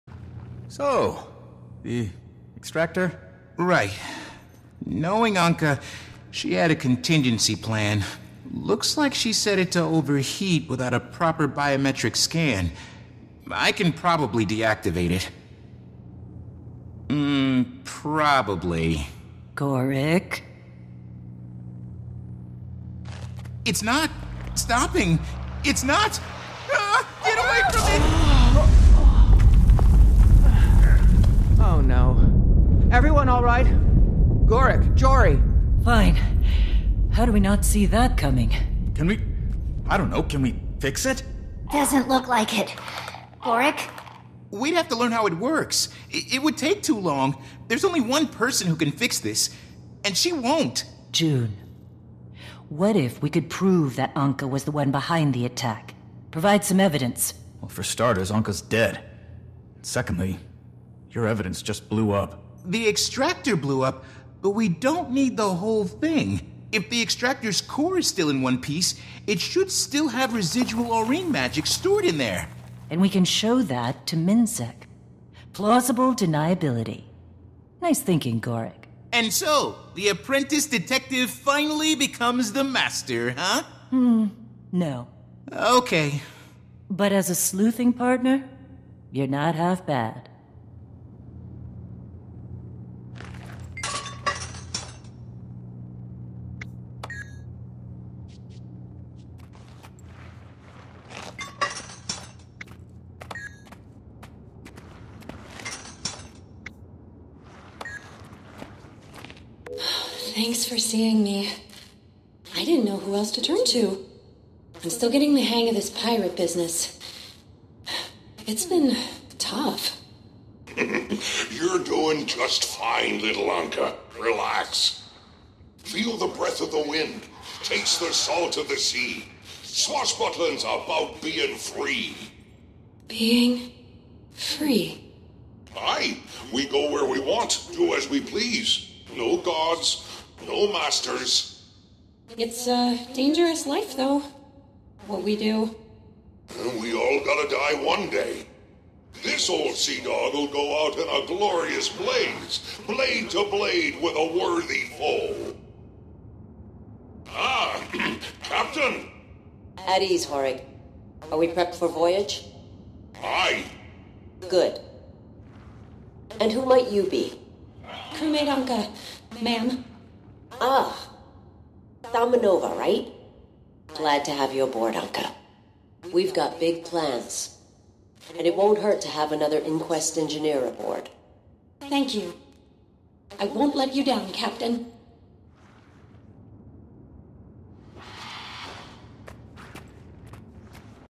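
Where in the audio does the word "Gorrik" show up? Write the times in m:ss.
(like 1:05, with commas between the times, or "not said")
0:19, 0:34, 0:43, 1:18.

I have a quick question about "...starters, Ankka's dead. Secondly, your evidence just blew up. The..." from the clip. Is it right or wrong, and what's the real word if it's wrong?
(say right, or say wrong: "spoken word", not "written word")
right.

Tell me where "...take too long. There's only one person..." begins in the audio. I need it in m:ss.
0:46.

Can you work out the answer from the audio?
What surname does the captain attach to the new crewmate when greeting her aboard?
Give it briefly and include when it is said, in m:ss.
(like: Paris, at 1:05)
Thalmanova, at 2:52.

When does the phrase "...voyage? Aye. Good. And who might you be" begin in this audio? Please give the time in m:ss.
2:41.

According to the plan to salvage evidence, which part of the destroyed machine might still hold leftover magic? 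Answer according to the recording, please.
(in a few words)
The extractor's core.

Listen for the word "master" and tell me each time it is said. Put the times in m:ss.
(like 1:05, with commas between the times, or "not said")
1:22, 2:20.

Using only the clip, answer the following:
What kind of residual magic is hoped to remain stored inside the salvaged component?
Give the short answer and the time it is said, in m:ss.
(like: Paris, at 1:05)
Aurene magic, at 1:10.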